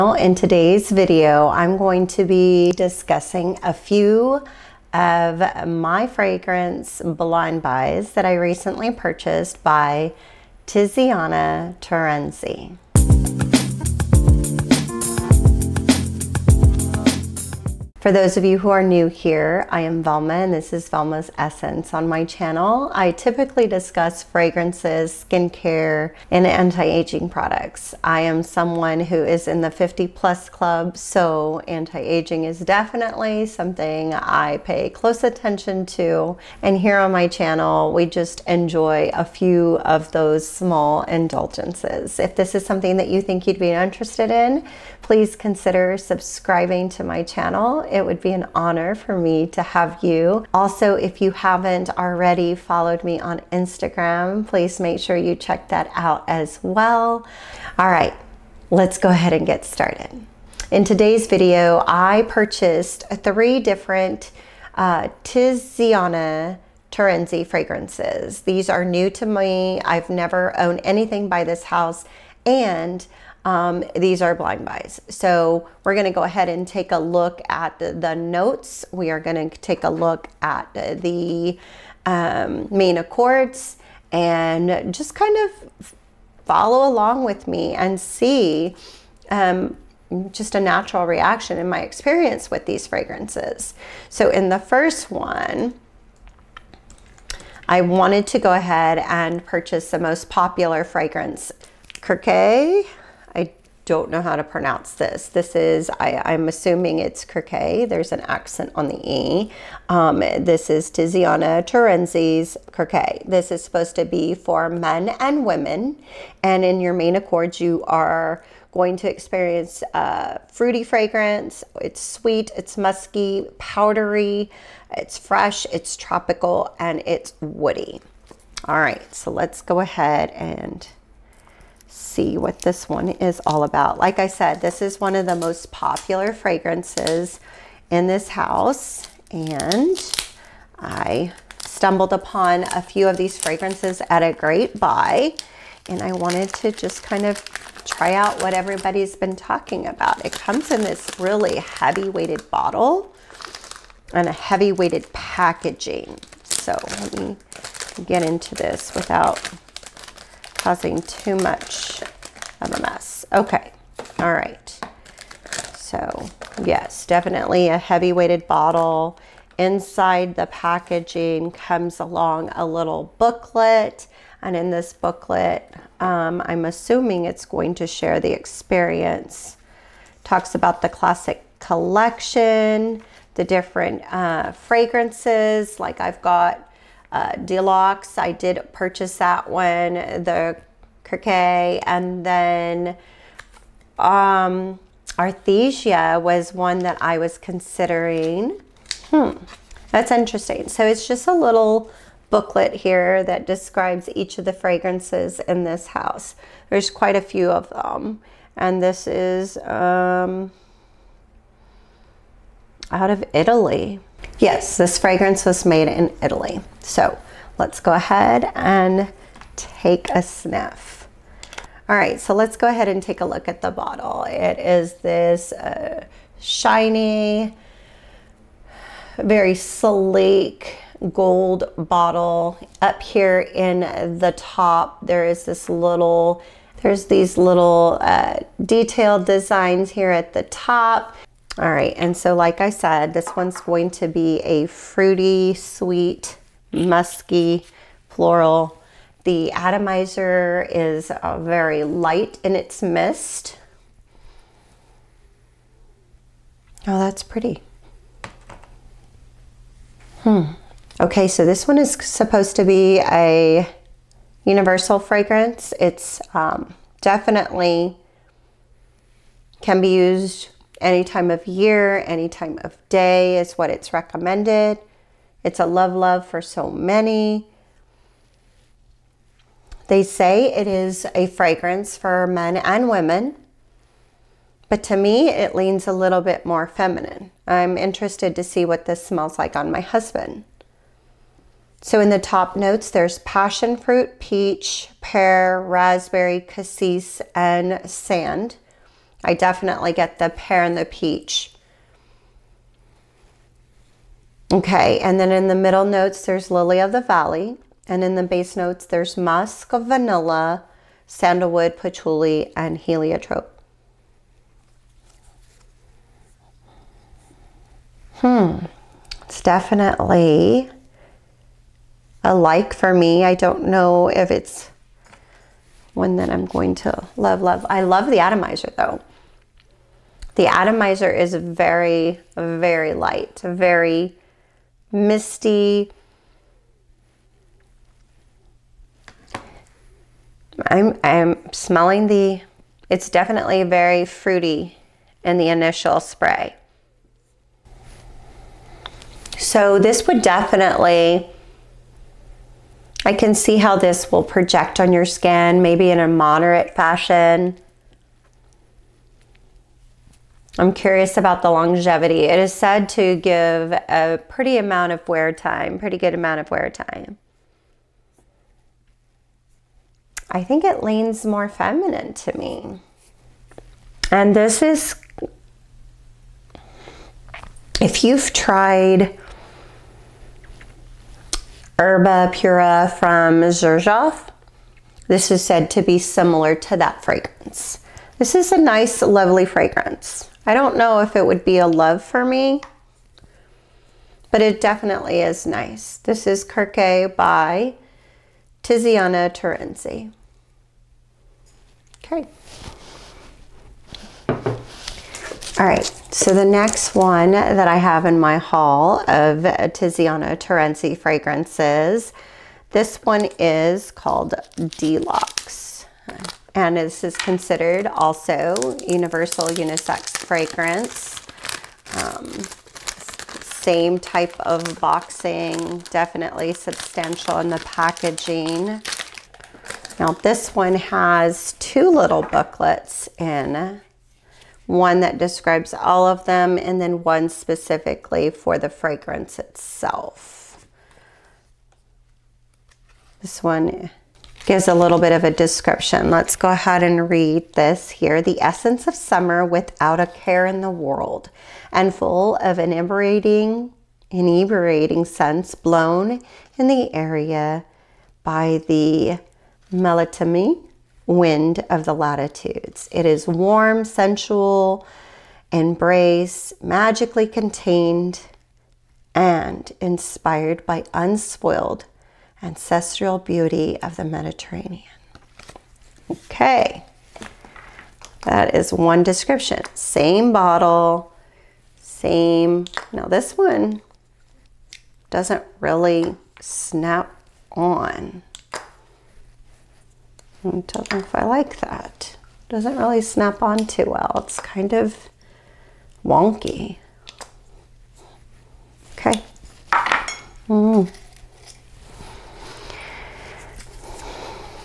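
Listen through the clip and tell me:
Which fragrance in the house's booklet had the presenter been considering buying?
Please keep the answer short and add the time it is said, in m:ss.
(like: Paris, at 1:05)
Arethusa, at 3:15.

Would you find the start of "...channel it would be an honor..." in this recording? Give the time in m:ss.
0:47.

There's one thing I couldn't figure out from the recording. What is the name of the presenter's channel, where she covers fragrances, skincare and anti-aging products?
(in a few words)
Velma's Essence.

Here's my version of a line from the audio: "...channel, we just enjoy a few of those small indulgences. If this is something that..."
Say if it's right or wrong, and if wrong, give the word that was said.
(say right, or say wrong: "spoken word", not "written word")
right.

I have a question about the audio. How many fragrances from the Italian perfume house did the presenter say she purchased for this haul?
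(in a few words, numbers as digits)
3.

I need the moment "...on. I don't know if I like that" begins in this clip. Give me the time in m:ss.
8:07.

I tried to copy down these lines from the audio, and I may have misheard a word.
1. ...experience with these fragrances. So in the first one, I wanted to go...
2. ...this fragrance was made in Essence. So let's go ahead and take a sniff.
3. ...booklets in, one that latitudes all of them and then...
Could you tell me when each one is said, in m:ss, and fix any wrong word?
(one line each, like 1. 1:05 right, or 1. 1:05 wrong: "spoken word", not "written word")
1. 1:31 right
2. 3:34 wrong: "Italy", not "Essence"
3. 7:12 wrong: "describes", not "latitudes".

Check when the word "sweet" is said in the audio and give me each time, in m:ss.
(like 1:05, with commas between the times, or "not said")
2:01, 4:05.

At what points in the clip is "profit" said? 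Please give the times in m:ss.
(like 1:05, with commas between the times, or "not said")
not said.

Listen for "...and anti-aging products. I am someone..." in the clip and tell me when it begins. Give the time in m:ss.
0:26.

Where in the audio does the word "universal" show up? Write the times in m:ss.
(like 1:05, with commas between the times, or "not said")
4:24, 6:58.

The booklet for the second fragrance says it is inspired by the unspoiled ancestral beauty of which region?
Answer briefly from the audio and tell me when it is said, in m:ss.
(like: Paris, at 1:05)
the Mediterranean, at 7:54.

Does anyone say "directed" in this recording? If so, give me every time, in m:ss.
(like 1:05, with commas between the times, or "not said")
not said.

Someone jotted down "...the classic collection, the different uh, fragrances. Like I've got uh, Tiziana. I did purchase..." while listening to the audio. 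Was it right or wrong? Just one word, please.
wrong.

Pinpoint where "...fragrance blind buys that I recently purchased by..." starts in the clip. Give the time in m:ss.
0:06.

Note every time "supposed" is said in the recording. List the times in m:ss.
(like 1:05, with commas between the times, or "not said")
1:53, 4:21.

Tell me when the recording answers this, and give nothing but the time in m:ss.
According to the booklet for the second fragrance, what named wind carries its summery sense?
7:39.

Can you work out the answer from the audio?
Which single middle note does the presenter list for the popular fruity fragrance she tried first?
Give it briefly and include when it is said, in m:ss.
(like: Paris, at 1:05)
Lily of the Valley, at 5:06.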